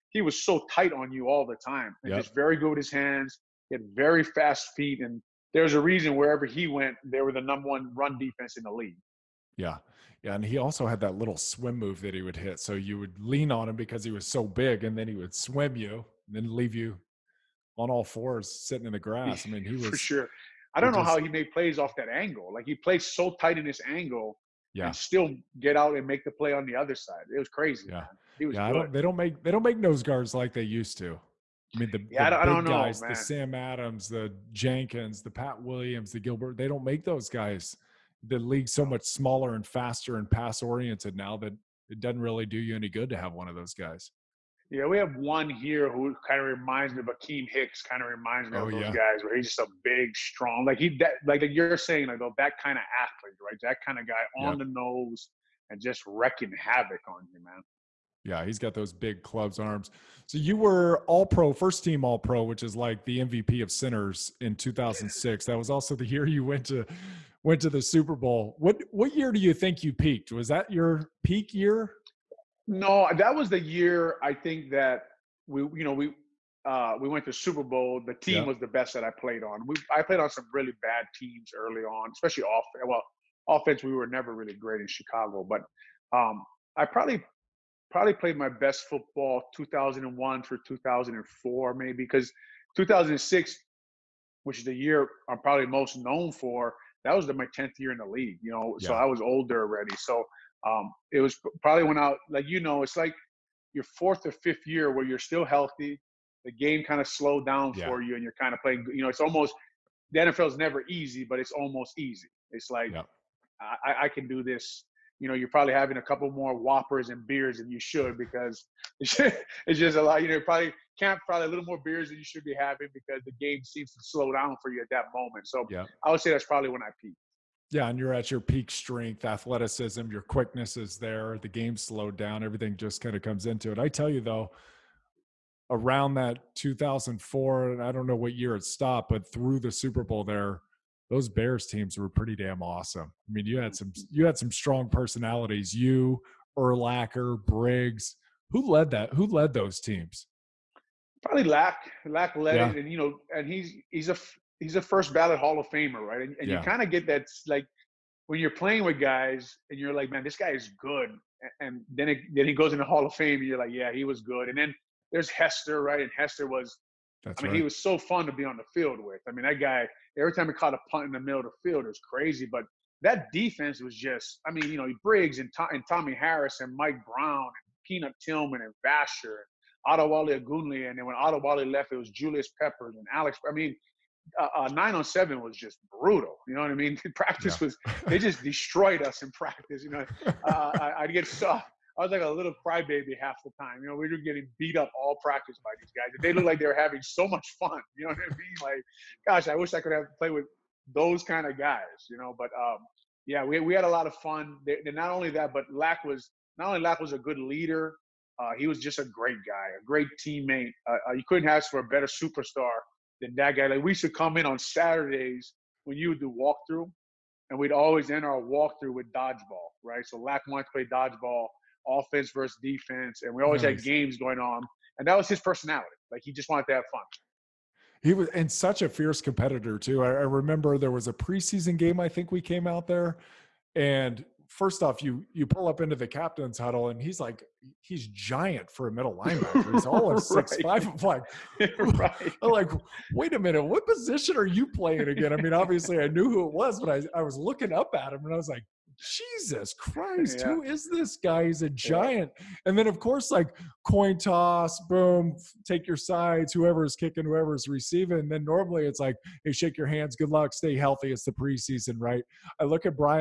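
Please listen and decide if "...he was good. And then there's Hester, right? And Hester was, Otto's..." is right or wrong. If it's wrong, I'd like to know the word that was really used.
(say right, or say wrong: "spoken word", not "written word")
wrong: "That", not "Otto".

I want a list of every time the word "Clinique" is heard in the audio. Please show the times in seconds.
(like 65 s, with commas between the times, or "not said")
not said.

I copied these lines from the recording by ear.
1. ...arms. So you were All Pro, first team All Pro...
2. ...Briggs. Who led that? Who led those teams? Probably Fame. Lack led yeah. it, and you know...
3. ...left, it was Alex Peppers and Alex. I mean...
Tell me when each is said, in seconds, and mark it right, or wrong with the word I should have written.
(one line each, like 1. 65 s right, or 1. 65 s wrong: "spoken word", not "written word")
1. 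59 s right
2. 147 s wrong: "Lack", not "Fame"
3. 181 s wrong: "Julius", not "Alex".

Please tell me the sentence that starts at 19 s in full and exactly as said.
I mean, he was for sure.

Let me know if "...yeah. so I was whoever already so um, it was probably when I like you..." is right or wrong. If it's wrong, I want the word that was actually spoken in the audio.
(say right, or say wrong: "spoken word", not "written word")
wrong: "older", not "whoever".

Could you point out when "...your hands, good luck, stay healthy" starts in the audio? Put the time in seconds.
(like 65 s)
259 s.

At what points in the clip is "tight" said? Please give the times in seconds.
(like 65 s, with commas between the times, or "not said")
0 s, 23 s.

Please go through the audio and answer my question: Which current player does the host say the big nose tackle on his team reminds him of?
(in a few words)
Akiem Hicks.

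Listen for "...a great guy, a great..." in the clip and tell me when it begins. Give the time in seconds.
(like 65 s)
208 s.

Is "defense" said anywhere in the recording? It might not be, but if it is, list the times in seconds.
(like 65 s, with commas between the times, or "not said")
8 s, 173 s, 222 s.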